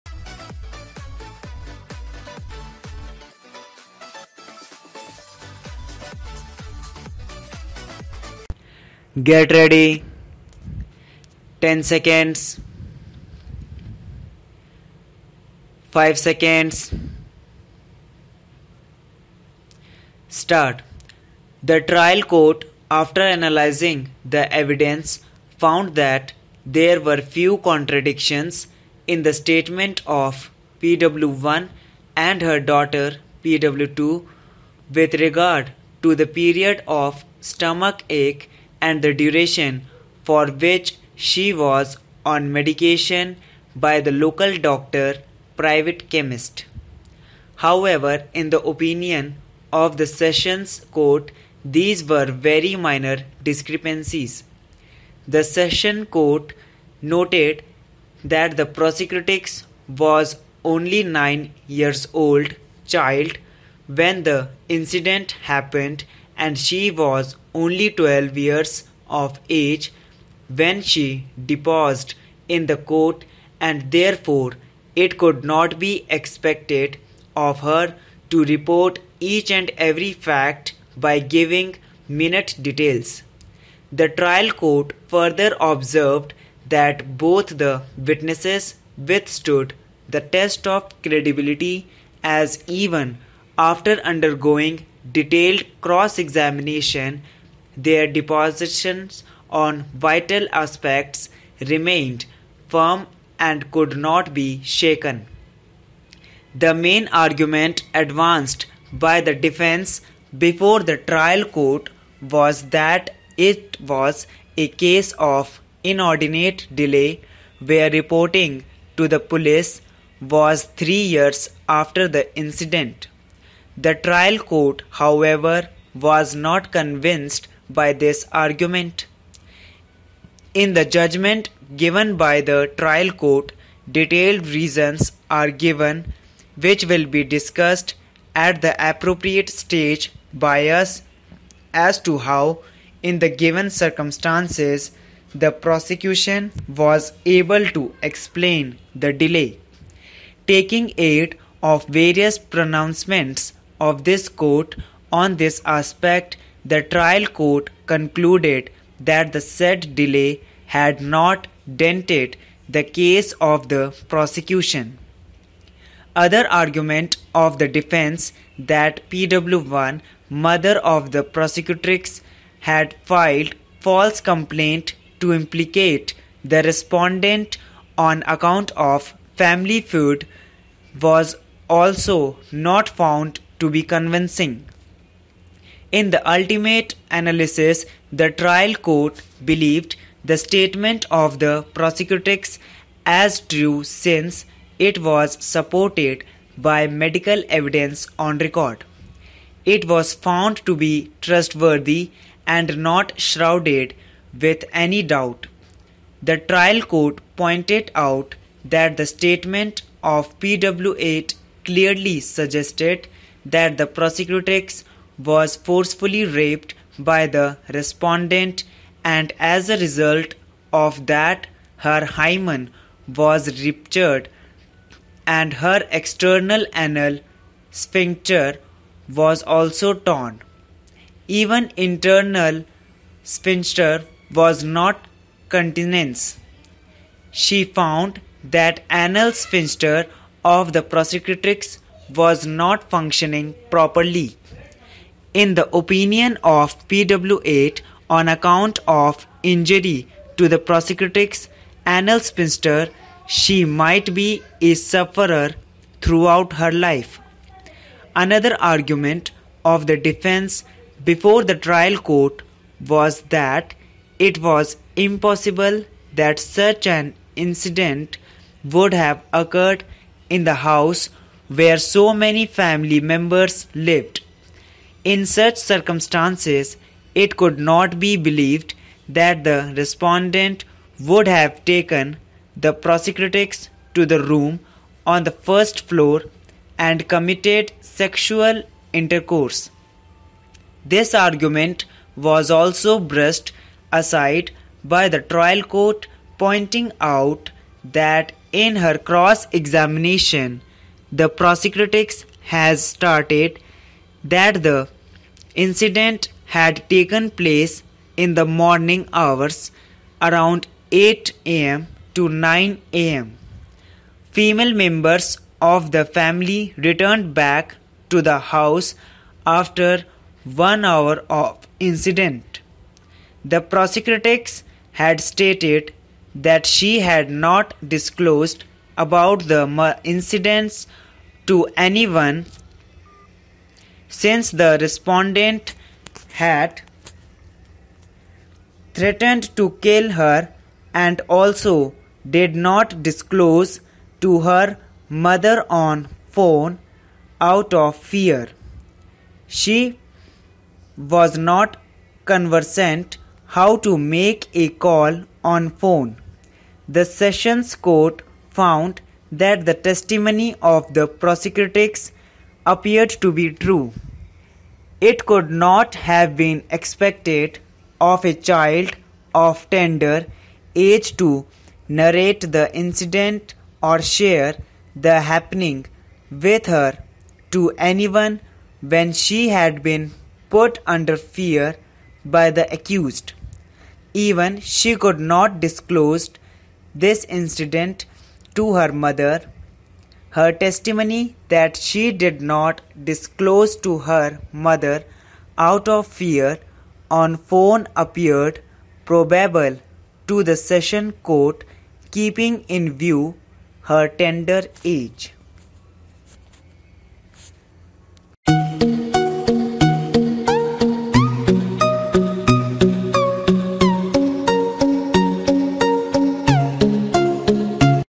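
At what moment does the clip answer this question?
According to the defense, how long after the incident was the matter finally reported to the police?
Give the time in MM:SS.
02:00.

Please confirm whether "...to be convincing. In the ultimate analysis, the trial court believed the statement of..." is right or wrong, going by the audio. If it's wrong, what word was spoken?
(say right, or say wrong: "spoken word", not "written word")
right.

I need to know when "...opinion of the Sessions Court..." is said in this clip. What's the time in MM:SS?
00:48.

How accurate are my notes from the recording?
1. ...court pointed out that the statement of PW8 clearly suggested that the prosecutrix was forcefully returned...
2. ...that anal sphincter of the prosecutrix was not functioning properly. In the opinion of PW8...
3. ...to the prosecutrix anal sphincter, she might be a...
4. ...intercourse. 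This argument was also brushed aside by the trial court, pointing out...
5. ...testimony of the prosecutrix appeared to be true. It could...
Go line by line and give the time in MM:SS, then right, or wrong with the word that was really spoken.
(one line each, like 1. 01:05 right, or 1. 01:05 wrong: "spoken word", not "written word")
1. 03:26 wrong: "raped", not "returned"
2. 03:58 right
3. 04:10 right
4. 04:48 right
5. 05:59 right.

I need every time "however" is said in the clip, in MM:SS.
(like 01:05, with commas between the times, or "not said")
00:47, 02:04.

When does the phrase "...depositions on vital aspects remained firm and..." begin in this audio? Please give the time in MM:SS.
01:38.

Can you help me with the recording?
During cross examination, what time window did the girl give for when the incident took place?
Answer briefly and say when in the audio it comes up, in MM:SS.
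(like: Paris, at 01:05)
8 am to 9 am, at 05:10.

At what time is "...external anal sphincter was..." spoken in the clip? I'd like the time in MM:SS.
03:45.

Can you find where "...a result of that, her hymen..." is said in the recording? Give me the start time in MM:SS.
03:39.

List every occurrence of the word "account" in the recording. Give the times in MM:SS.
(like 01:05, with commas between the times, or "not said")
02:58, 04:08.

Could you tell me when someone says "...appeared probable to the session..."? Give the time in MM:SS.
06:37.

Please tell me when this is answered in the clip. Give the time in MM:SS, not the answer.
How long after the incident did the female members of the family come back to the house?
05:20.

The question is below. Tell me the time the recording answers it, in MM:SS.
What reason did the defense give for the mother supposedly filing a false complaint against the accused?
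02:59.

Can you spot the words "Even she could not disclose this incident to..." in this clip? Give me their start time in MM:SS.
06:24.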